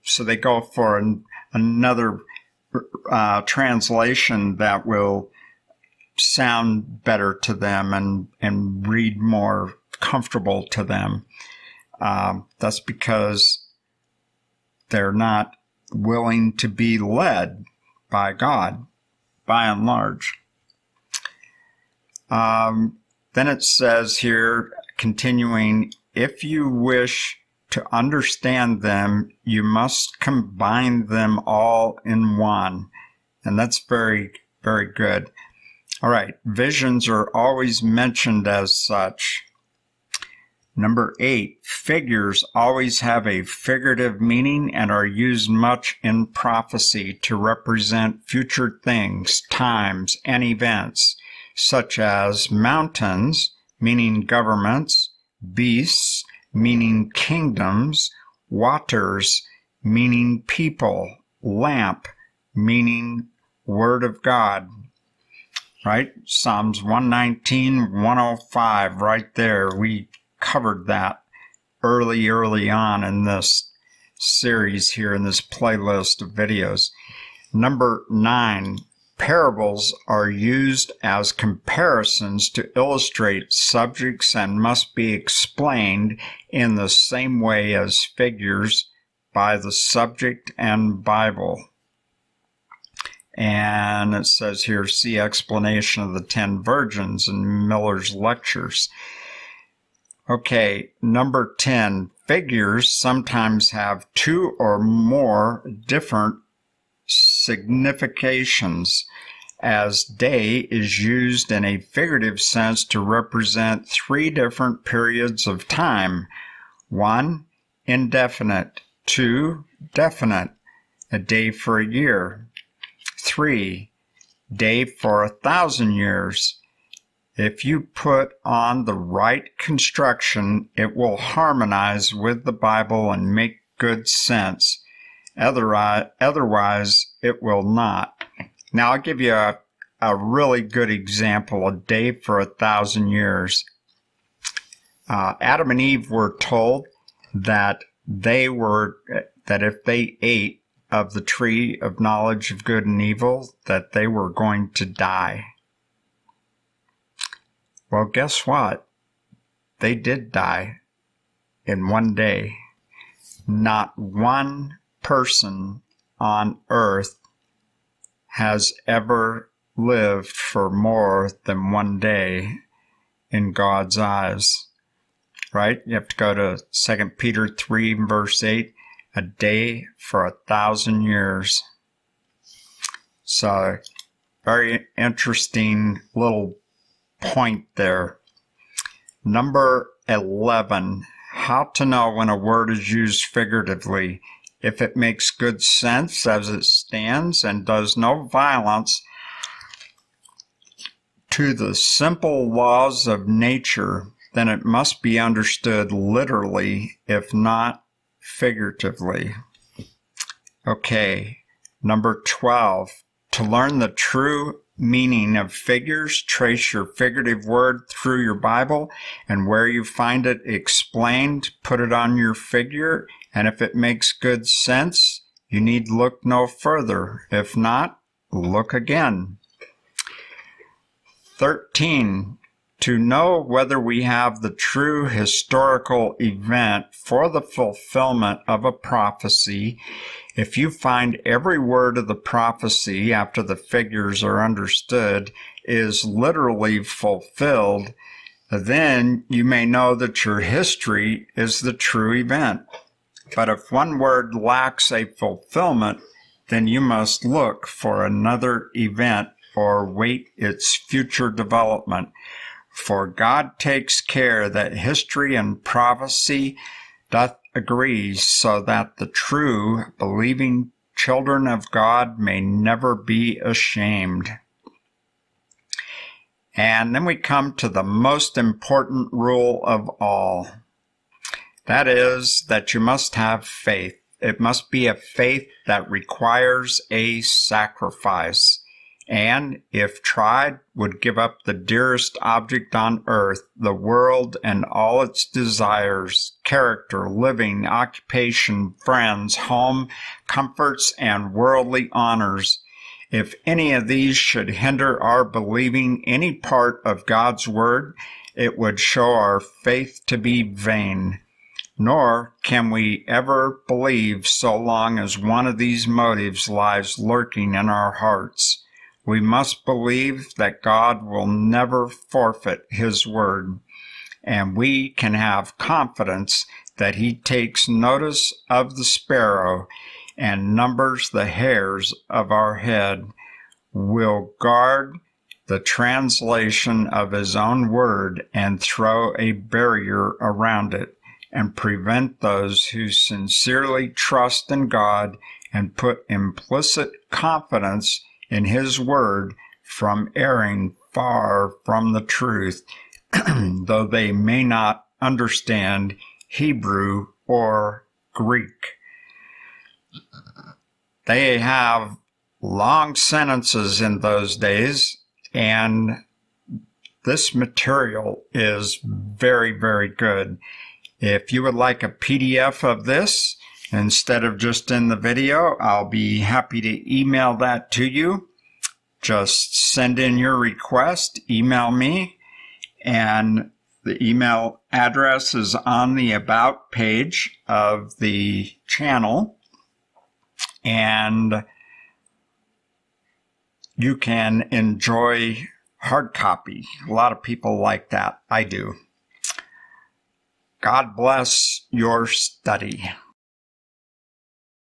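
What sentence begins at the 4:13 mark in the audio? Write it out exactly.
But if one word lacks a fulfillment, then you must look for another event or wait its future development.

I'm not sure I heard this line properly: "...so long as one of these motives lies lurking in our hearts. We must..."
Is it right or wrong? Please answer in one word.
right.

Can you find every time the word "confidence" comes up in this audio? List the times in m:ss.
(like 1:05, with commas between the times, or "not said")
5:25, 5:47.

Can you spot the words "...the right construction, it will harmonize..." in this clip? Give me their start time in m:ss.
2:08.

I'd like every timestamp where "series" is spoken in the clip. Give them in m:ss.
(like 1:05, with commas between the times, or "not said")
1:14.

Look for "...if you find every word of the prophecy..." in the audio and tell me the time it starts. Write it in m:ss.
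4:00.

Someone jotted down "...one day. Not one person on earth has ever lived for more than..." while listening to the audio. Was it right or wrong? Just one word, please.
right.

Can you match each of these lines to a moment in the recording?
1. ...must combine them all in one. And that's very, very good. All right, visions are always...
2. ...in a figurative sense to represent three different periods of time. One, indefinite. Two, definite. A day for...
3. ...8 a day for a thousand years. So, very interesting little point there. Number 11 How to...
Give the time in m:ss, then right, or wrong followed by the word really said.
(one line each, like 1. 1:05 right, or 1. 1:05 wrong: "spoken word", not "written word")
1. 0:29 right
2. 1:51 right
3. 2:58 right.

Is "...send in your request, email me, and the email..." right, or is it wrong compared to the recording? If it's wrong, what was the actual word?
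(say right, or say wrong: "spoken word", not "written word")
right.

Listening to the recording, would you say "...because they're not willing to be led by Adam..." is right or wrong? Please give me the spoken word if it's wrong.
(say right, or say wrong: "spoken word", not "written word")
wrong: "God", not "Adam".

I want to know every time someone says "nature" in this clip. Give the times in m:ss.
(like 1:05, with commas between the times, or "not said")
3:23.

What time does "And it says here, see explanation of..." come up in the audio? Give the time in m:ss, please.
1:33.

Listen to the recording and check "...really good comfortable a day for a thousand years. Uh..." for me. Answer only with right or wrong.
wrong.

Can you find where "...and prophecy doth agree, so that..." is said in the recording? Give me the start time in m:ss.
4:25.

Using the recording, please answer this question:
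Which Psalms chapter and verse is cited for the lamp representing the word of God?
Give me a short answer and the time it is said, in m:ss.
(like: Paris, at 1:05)
Psalms 119:105, at 1:06.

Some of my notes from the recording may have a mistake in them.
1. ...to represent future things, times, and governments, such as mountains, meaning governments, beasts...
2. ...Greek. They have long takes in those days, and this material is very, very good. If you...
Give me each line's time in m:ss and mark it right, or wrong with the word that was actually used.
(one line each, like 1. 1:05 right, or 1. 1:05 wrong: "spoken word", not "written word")
1. 0:47 wrong: "events", not "governments"
2. 5:58 wrong: "sentences", not "takes".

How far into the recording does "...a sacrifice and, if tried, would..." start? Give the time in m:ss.
4:46.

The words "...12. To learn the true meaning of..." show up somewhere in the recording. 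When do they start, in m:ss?
3:32.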